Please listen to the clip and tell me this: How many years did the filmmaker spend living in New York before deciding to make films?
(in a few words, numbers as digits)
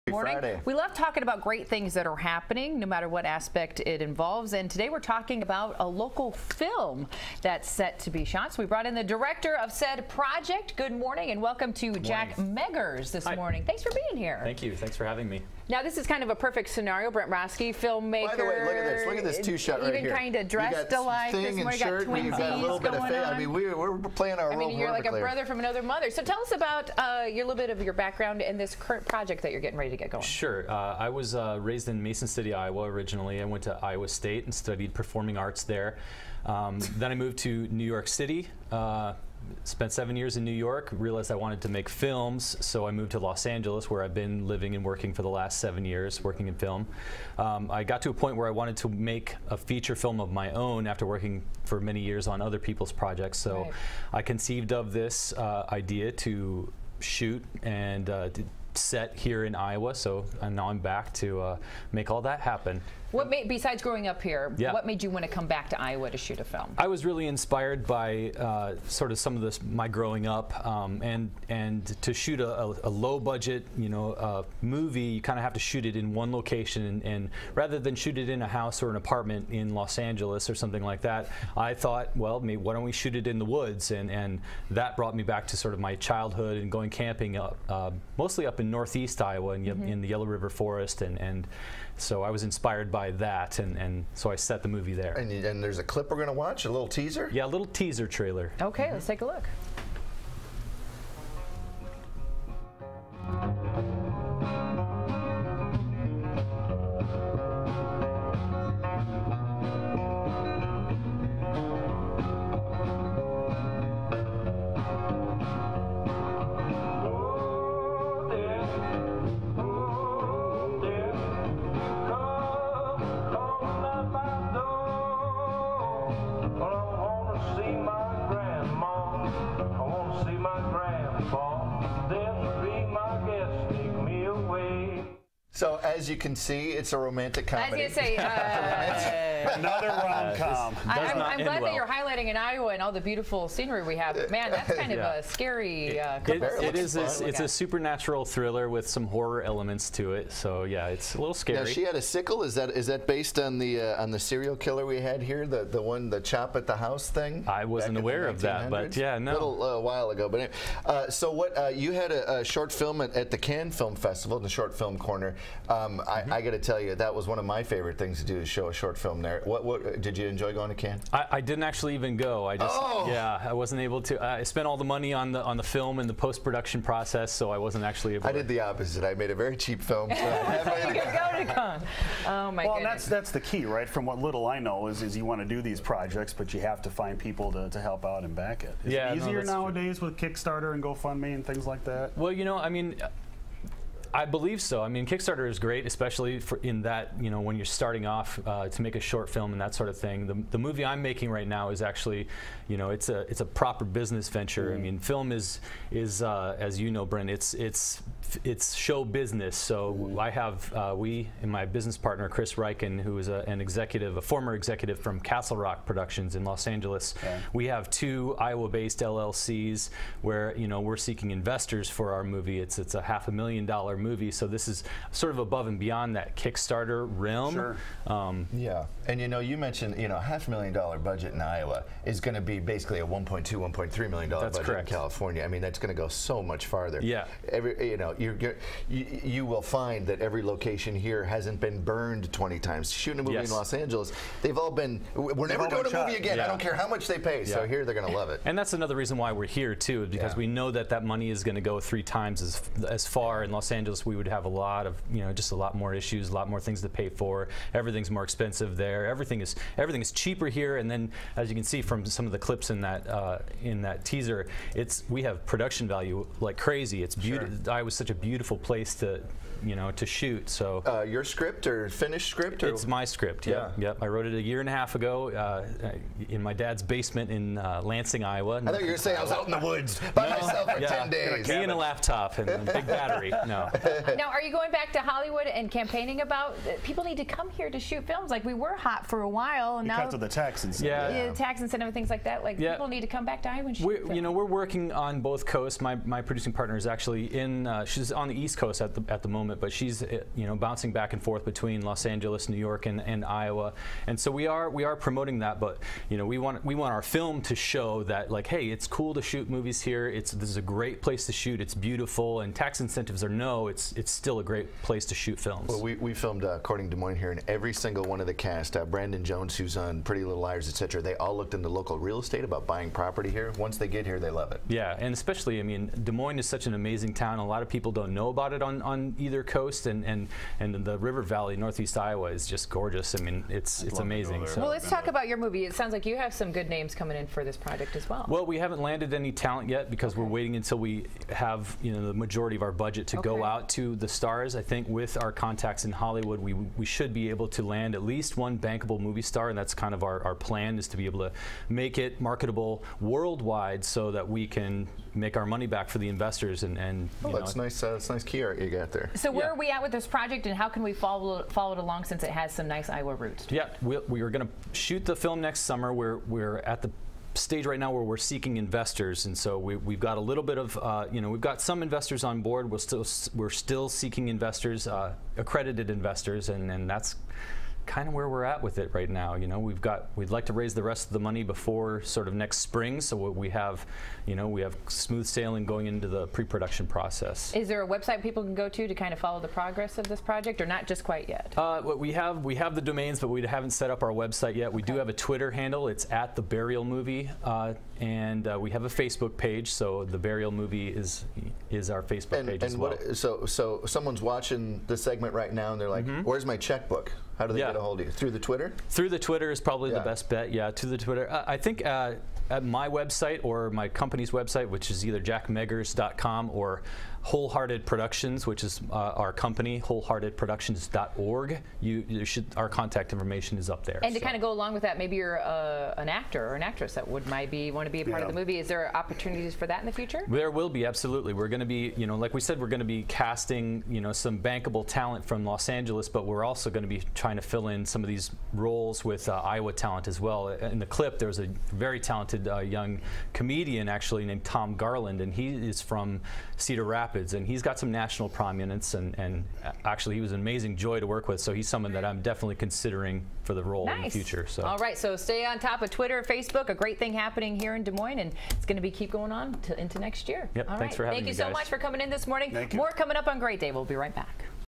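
7.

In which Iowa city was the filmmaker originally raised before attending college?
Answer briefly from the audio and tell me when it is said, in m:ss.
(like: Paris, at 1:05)
Mason City, at 0:32.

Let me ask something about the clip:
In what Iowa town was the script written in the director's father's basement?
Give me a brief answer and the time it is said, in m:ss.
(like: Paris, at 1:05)
Lansing, at 4:37.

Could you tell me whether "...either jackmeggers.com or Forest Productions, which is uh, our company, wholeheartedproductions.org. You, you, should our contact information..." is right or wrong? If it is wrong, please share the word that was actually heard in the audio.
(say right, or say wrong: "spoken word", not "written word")
wrong: "Wholehearted", not "Forest".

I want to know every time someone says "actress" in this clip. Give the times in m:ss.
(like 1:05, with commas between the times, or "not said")
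7:06.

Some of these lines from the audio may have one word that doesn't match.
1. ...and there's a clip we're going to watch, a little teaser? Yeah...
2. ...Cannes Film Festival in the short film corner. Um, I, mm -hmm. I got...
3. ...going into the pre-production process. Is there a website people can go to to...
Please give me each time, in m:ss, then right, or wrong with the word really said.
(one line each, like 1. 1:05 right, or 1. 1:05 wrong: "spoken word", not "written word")
1. 1:35 right
2. 2:43 right
3. 6:25 right.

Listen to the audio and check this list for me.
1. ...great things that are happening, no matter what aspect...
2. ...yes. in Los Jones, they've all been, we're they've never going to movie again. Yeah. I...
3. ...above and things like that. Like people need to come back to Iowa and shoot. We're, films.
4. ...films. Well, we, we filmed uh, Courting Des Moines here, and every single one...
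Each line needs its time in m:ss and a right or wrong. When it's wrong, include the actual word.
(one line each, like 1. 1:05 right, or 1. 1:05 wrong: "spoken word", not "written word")
1. 0:01 right
2. 4:03 wrong: "Angeles", not "Jones"
3. 4:51 wrong: "incentive", not "above"
4. 5:15 right.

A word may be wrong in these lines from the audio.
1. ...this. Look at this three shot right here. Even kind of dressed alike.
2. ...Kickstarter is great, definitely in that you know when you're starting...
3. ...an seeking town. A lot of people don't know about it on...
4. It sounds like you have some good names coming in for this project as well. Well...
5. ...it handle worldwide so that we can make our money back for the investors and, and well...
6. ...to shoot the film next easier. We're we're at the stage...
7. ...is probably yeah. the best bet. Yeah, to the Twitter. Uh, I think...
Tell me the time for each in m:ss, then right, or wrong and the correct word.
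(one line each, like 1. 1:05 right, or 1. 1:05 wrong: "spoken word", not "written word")
1. 0:18 wrong: "two", not "three"
2. 3:15 wrong: "especially", not "definitely"
3. 5:26 wrong: "amazing", not "seeking"
4. 5:35 right
5. 5:51 wrong: "marketable", not "handle"
6. 6:04 wrong: "summer", not "easier"
7. 6:49 right.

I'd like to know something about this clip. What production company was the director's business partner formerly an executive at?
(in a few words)
Castle Rock Productions.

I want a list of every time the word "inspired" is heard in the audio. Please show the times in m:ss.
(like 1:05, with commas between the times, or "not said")
1:07, 1:32.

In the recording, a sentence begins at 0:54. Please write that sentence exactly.
I conceived of this uh, idea to shoot and uh, set here in Iowa.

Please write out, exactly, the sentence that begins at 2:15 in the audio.
So as you can see, it's a romantic comedy.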